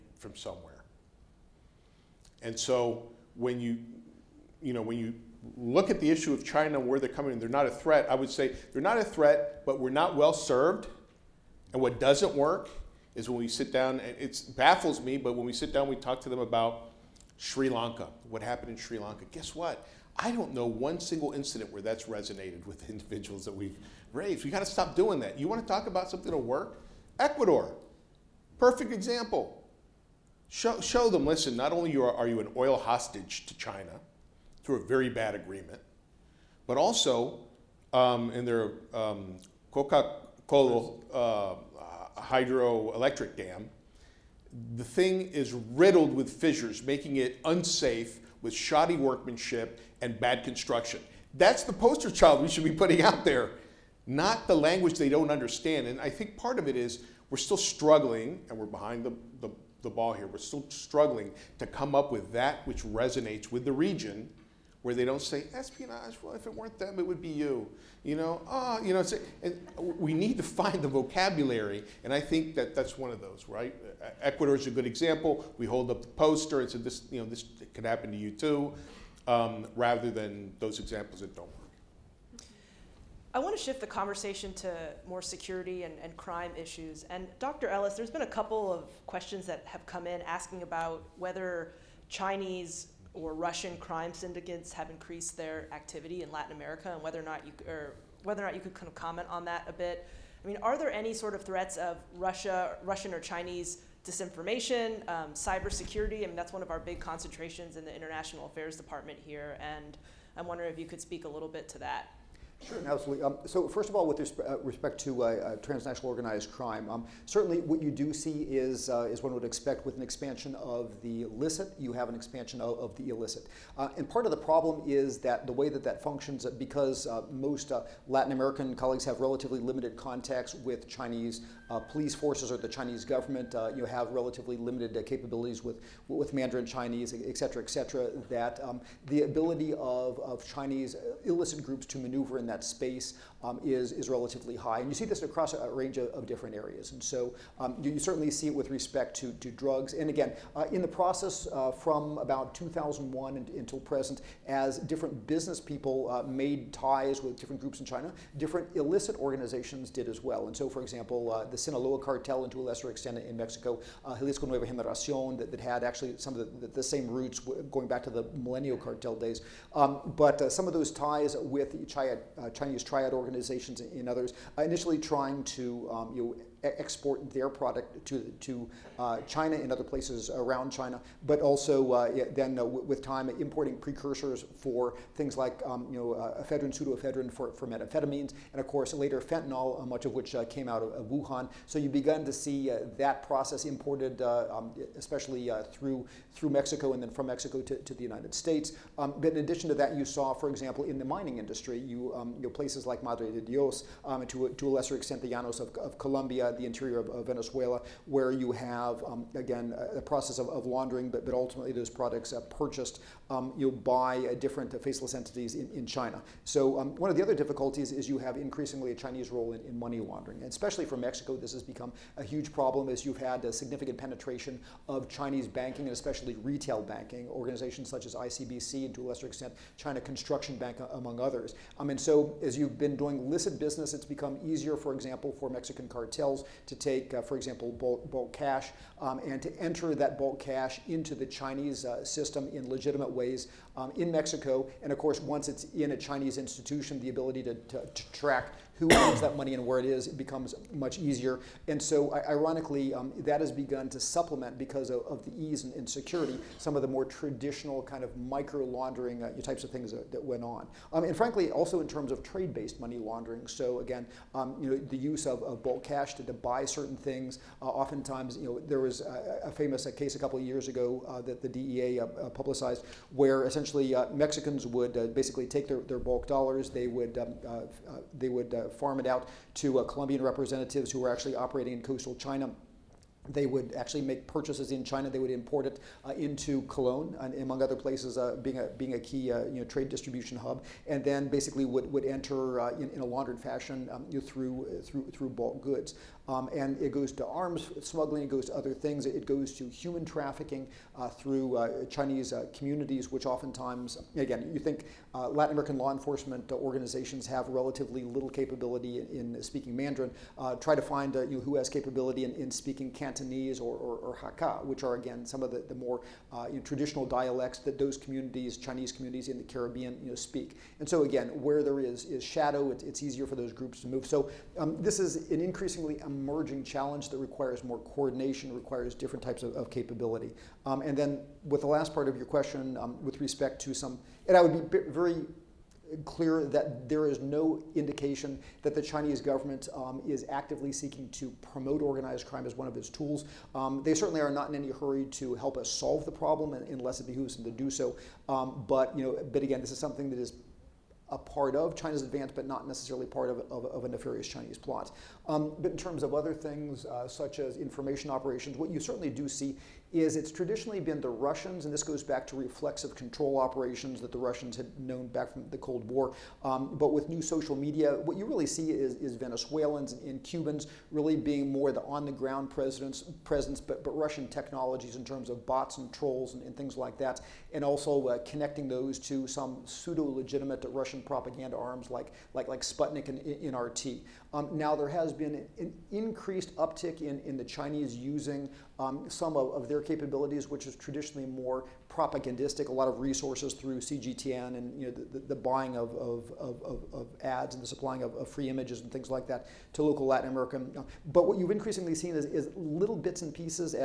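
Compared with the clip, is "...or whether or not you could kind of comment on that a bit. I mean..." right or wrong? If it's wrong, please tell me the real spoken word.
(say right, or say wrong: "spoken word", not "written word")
right.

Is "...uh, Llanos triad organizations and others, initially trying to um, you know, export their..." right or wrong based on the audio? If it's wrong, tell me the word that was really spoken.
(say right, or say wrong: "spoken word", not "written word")
wrong: "Chinese", not "Llanos".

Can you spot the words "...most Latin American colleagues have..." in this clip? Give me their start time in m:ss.
2:07.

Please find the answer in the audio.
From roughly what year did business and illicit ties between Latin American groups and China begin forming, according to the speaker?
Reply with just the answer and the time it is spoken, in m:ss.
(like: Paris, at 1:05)
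2001, at 2:32.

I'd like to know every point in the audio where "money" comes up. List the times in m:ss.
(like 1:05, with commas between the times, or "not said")
3:39, 4:09, 4:22.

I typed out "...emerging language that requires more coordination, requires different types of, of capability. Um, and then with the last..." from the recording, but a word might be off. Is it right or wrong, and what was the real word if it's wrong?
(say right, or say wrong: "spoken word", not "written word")
wrong: "challenge", not "language".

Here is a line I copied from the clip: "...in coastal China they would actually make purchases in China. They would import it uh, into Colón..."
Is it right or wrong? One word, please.
right.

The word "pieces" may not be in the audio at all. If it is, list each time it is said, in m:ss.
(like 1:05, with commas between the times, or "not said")
6:43.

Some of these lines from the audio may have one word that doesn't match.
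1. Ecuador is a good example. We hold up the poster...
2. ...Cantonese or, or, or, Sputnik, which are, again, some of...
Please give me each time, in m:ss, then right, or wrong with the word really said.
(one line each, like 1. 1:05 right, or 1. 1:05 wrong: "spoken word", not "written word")
1. 1:14 right
2. 5:12 wrong: "Hakka", not "Sputnik".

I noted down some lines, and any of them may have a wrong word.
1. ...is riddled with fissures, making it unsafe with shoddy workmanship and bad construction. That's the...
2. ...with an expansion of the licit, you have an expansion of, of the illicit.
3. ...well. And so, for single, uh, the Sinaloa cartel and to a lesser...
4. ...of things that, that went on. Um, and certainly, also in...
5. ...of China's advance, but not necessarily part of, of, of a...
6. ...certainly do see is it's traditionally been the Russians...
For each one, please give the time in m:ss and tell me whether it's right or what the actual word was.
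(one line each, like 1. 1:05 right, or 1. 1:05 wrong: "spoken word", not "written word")
1. 0:45 right
2. 1:59 right
3. 2:40 wrong: "example", not "single"
4. 4:19 wrong: "frankly", not "certainly"
5. 5:51 right
6. 5:58 right.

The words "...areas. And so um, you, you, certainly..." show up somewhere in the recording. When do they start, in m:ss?
2:26.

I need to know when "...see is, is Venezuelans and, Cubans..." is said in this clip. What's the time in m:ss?
6:08.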